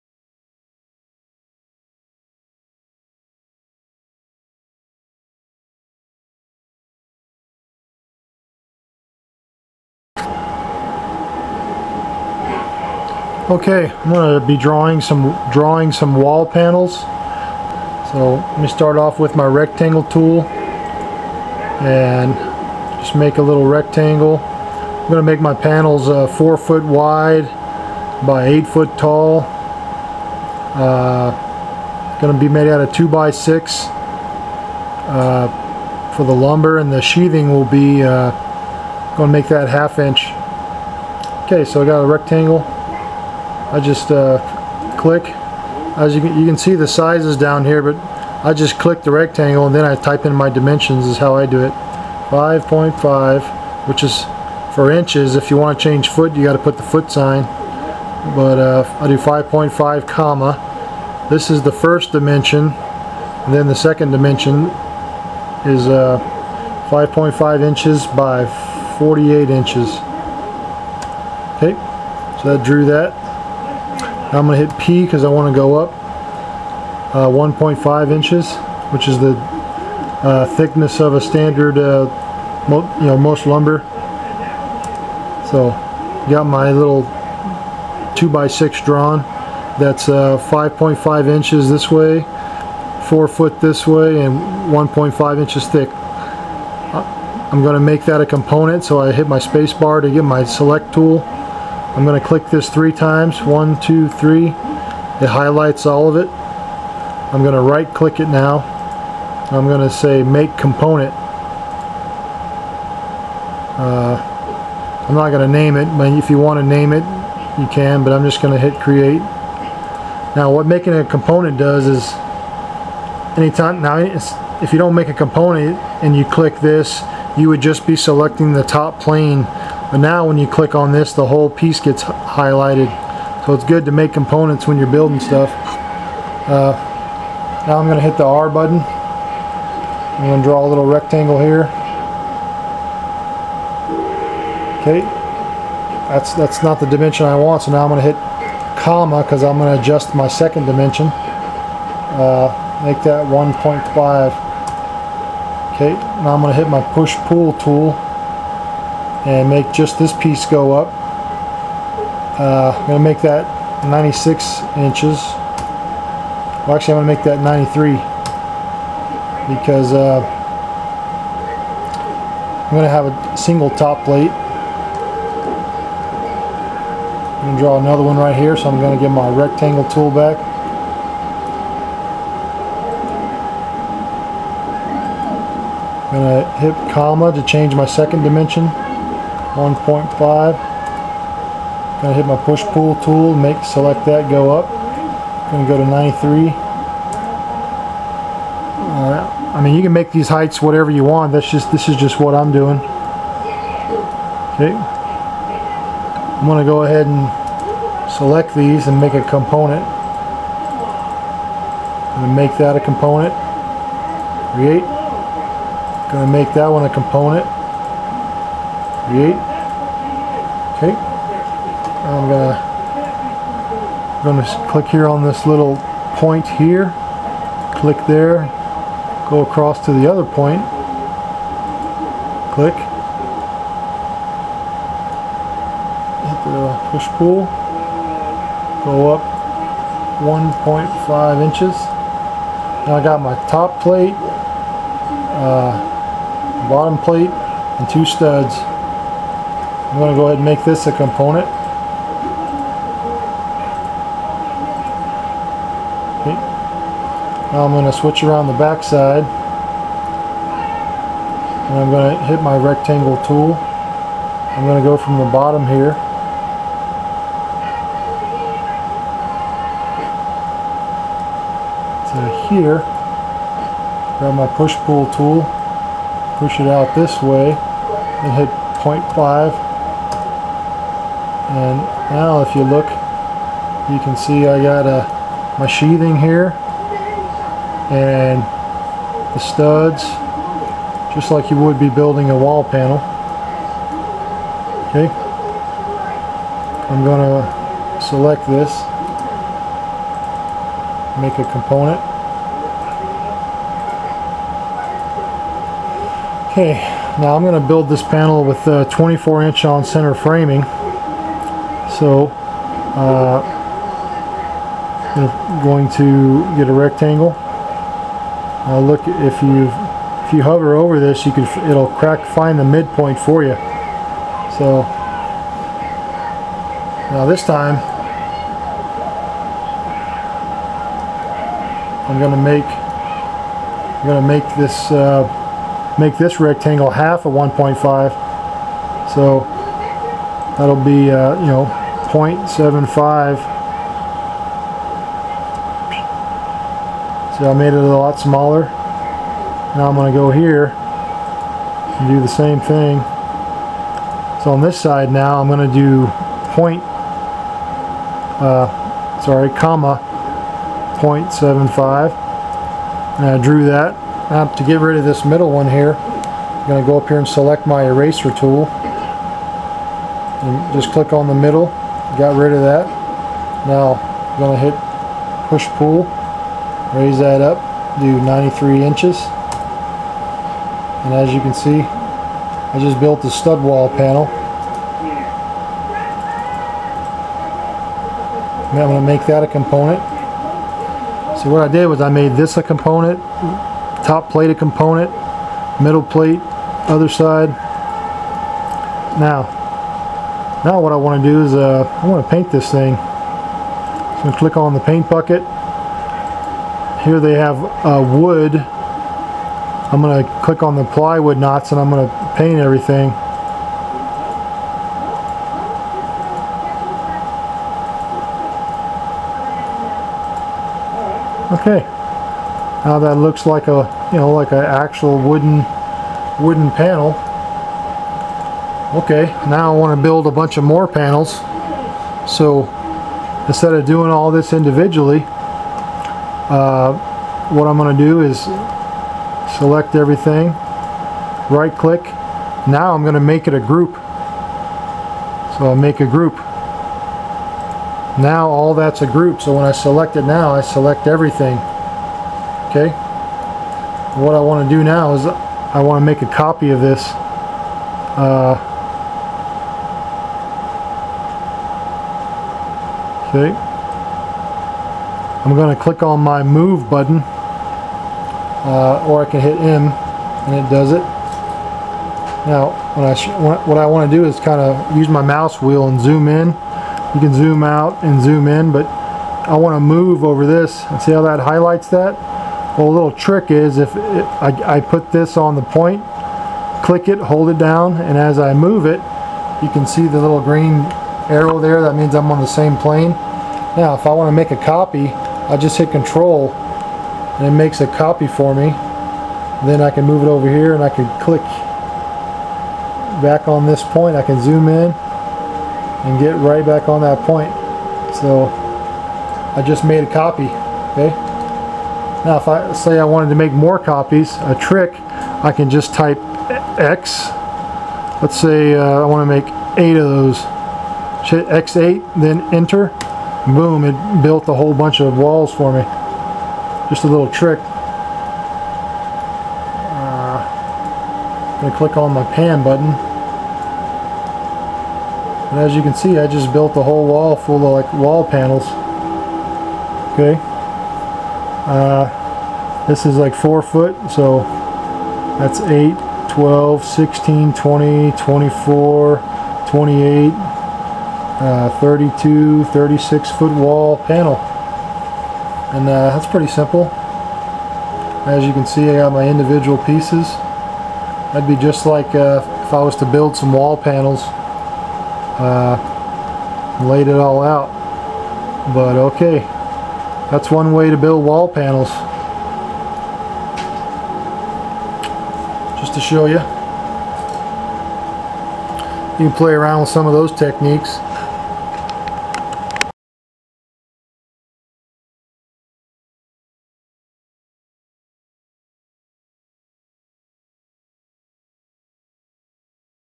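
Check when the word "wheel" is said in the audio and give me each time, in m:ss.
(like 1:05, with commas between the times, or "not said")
7:55.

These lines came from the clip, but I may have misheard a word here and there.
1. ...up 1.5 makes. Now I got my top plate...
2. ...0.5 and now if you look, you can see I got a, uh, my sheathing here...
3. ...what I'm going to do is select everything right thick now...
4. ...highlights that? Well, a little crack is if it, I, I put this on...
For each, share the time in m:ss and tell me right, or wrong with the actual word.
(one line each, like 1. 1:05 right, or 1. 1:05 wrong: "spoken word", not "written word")
1. 3:59 wrong: "inches", not "makes"
2. 4:38 right
3. 7:17 wrong: "click", not "thick"
4. 8:01 wrong: "trick", not "crack".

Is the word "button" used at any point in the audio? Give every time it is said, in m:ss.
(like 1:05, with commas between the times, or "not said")
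2:18, 7:46, 8:52.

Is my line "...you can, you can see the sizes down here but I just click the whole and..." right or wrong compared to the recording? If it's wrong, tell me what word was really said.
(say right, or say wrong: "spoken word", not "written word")
wrong: "rectangle", not "whole".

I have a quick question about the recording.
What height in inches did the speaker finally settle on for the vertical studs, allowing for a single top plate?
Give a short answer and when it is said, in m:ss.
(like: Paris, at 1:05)
93, at 2:47.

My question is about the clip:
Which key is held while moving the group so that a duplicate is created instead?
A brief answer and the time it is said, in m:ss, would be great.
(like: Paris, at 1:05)
control, at 8:15.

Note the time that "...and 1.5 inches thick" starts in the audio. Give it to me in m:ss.
1:34.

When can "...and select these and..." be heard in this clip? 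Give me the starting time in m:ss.
3:27.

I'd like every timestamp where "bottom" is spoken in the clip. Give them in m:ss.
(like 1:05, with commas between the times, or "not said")
4:06, 4:25.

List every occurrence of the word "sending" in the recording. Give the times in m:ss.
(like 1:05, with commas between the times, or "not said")
not said.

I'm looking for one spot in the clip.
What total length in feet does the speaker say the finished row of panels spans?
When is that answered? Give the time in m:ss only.
9:12.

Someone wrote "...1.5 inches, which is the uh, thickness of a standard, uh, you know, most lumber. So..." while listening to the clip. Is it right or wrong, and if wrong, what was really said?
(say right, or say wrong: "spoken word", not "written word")
right.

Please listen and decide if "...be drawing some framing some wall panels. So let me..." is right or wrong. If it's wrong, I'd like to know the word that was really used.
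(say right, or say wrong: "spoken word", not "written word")
wrong: "drawing", not "framing".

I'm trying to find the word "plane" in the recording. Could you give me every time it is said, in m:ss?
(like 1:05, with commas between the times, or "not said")
2:09, 8:12.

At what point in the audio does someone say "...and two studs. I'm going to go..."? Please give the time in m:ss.
4:07.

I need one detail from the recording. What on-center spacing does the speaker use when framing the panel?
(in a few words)
24 inch.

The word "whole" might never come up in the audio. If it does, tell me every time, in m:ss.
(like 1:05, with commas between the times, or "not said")
2:11, 8:44, 8:56.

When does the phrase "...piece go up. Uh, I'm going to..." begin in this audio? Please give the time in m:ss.
2:40.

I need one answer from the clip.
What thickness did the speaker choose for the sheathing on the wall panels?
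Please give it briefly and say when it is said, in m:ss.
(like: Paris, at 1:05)
half inch, at 0:39.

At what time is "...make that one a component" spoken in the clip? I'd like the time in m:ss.
3:36.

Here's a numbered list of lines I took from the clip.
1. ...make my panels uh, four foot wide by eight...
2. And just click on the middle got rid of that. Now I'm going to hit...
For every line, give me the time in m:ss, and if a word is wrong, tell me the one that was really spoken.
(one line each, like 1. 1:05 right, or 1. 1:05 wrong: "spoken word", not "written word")
1. 0:25 right
2. 6:10 right.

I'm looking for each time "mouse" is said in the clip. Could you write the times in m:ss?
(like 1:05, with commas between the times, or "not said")
7:55.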